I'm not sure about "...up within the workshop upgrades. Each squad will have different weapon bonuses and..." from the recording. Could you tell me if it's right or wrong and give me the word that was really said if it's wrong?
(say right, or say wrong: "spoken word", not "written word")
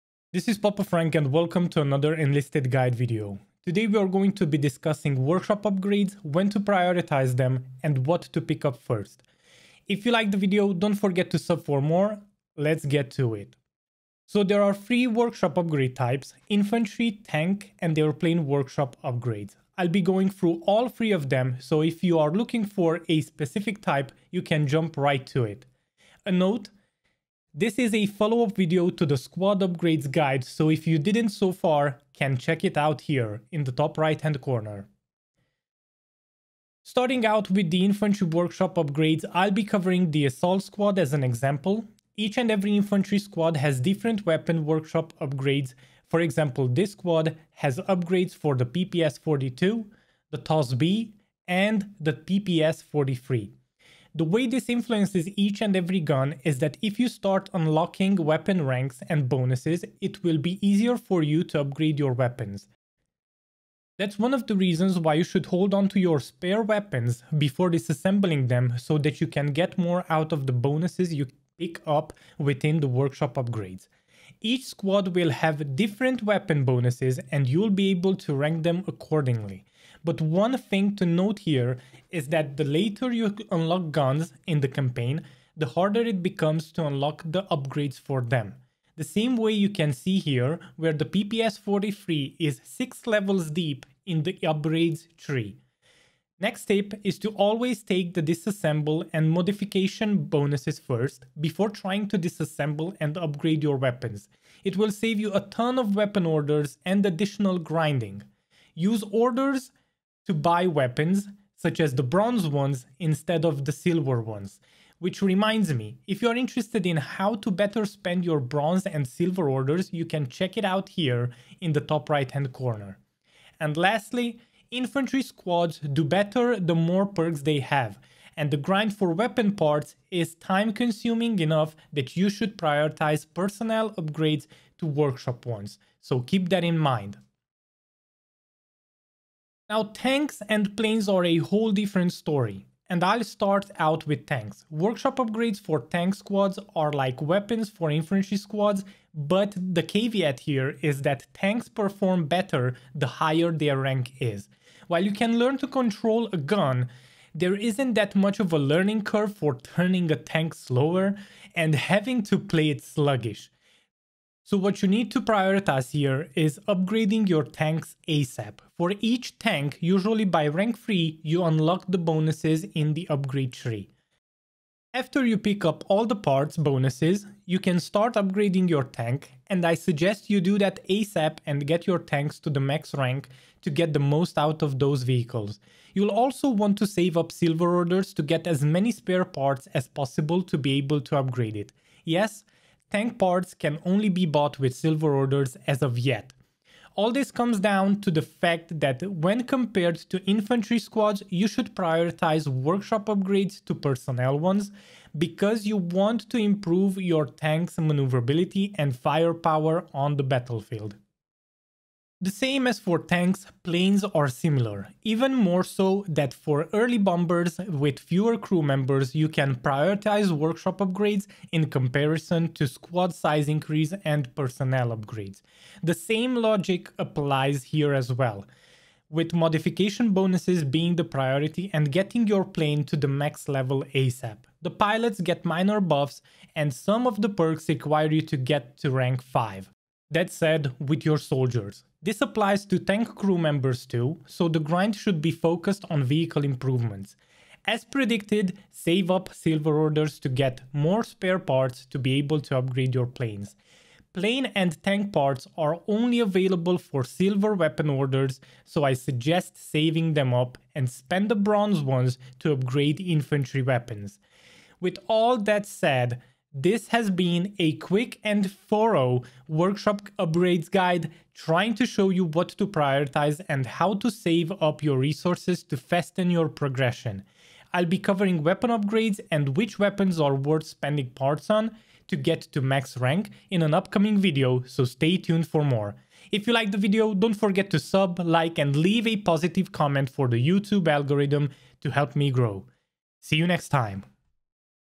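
right.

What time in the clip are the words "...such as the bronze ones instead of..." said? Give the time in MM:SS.
01:51.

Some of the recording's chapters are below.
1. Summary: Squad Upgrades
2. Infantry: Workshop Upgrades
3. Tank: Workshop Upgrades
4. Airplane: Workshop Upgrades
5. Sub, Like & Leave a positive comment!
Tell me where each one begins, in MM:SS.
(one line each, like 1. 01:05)
1. 00:14
2. 00:35
3. 02:20
4. 03:30
5. 04:25.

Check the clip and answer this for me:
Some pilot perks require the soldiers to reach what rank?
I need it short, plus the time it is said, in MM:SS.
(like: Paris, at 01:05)
Rank 5, at 03:58.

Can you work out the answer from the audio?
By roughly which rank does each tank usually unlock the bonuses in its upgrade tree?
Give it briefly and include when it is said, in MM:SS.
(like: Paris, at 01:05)
Rank 3, at 02:50.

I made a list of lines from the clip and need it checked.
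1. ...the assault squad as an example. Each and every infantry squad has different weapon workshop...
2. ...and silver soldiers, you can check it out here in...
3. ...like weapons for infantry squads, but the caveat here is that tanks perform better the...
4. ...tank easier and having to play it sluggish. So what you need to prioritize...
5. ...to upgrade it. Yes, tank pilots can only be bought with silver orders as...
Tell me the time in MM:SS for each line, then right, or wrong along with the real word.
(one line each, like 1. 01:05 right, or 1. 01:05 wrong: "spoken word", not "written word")
1. 00:40 right
2. 01:58 wrong: "orders", not "soldiers"
3. 02:26 right
4. 02:40 wrong: "slower", not "easier"
5. 03:11 wrong: "parts", not "pilots".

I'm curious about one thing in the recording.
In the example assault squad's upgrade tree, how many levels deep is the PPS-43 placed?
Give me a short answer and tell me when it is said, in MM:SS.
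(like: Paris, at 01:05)
6, at 01:32.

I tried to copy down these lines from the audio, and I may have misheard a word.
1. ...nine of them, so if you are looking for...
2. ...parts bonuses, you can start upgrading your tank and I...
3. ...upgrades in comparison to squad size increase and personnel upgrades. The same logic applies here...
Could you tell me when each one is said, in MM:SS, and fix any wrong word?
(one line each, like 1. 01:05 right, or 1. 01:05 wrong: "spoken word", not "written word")
1. 00:20 wrong: "three", not "nine"
2. 02:56 right
3. 03:40 right.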